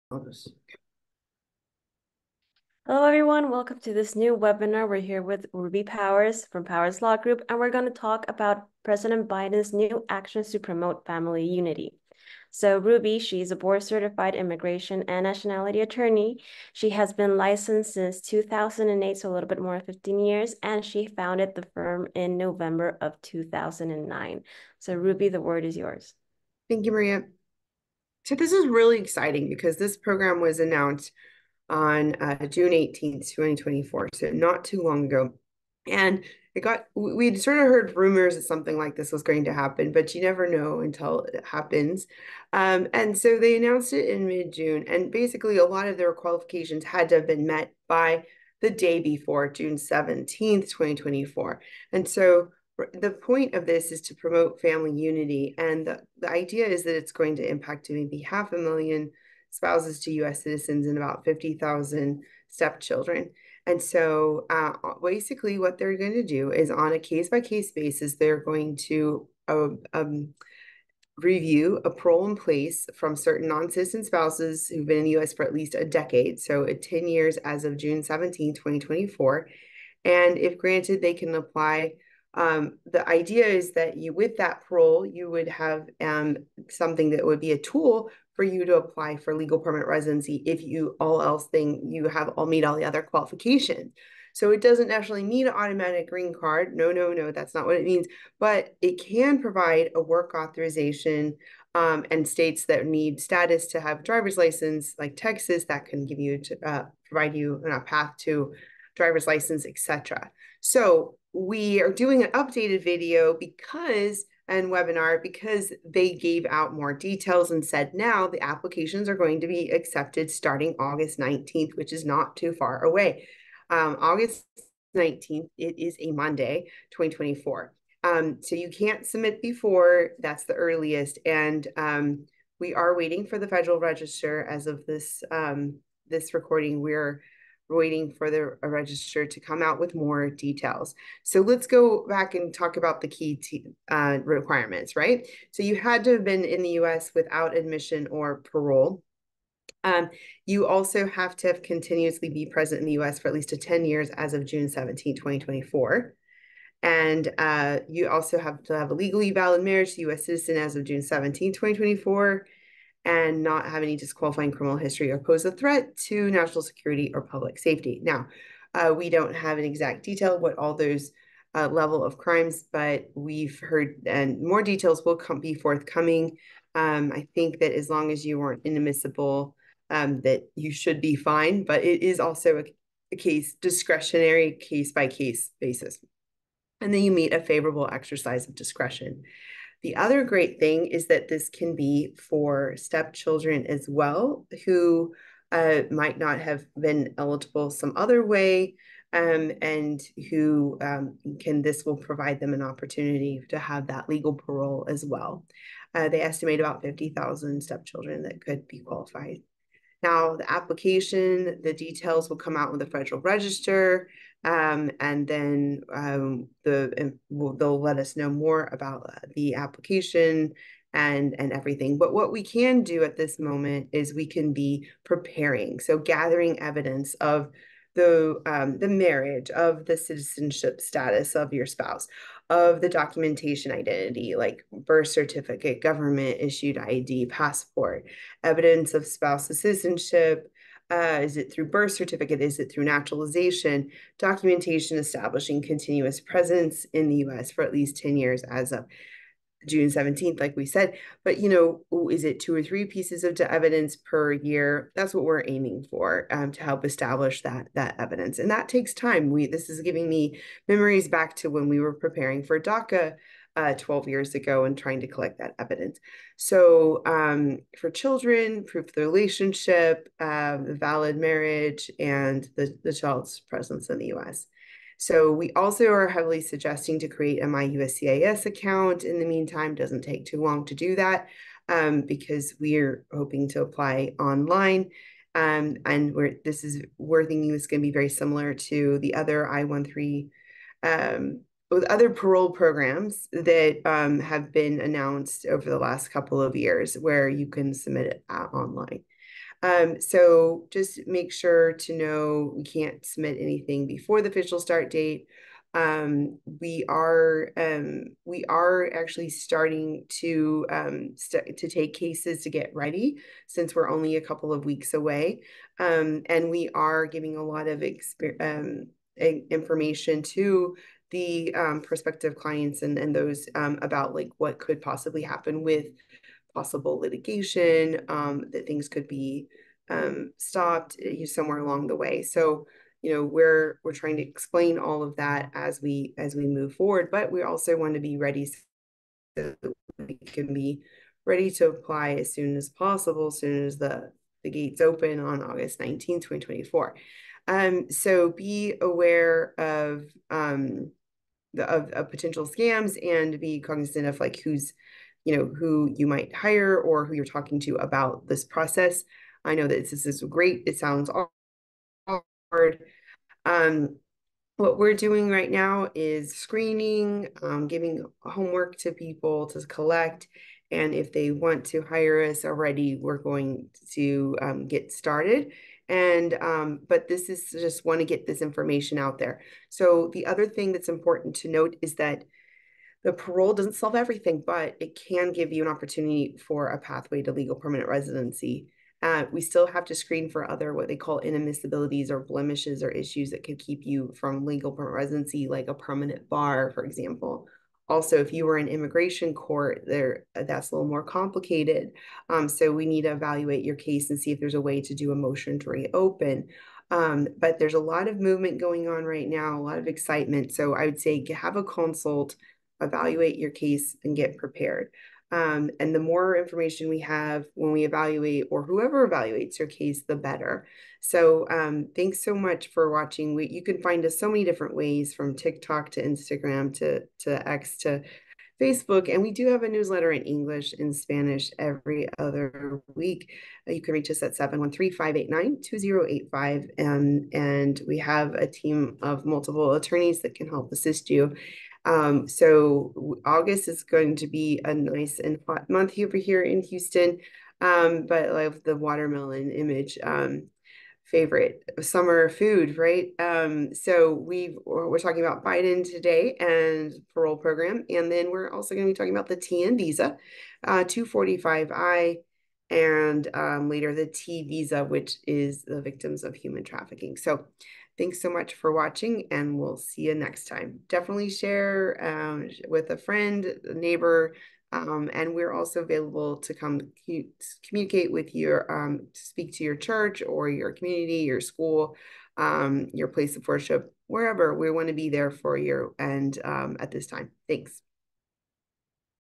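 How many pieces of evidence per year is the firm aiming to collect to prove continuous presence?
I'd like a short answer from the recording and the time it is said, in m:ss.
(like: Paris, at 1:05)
2 or 3, at 4:12.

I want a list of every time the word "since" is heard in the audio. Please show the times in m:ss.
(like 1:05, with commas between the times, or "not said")
0:17, 5:13.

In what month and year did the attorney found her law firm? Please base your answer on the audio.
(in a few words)
November 2009.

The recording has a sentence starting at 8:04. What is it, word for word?
We want to be there for you and um, at this time.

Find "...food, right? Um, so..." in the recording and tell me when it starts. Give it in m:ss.
7:32.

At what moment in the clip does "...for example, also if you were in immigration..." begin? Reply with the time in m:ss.
6:36.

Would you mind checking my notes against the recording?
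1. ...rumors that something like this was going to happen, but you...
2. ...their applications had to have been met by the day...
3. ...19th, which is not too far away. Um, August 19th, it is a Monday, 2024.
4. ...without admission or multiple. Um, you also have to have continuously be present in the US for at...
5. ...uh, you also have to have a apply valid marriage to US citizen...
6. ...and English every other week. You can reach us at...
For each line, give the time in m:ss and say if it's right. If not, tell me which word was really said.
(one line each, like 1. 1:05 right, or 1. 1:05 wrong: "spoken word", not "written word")
1. 0:37 right
2. 0:45 wrong: "qualifications", not "applications"
3. 2:01 right
4. 2:27 wrong: "parole", not "multiple"
5. 2:37 wrong: "legally", not "apply"
6. 7:10 wrong: "Spanish", not "English".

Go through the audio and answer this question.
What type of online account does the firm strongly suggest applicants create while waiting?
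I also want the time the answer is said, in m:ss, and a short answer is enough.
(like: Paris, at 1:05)
MyUSCIS account, at 4:37.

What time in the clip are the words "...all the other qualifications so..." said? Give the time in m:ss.
1:32.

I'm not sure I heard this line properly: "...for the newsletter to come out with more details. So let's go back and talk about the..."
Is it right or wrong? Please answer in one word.
wrong.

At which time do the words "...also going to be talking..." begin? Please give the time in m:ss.
7:38.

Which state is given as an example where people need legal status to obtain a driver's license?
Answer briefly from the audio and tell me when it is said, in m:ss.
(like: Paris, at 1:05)
Texas, at 1:45.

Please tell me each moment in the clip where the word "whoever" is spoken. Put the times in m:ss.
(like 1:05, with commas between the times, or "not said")
6:58.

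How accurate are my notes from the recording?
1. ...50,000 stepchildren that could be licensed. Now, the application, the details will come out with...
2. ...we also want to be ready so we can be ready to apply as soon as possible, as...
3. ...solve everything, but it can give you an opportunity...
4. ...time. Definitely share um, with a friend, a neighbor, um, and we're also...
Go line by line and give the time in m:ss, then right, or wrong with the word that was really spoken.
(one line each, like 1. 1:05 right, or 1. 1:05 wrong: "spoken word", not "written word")
1. 3:26 wrong: "qualified", not "licensed"
2. 5:37 right
3. 6:23 right
4. 7:50 right.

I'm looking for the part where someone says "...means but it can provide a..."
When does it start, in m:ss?
1:37.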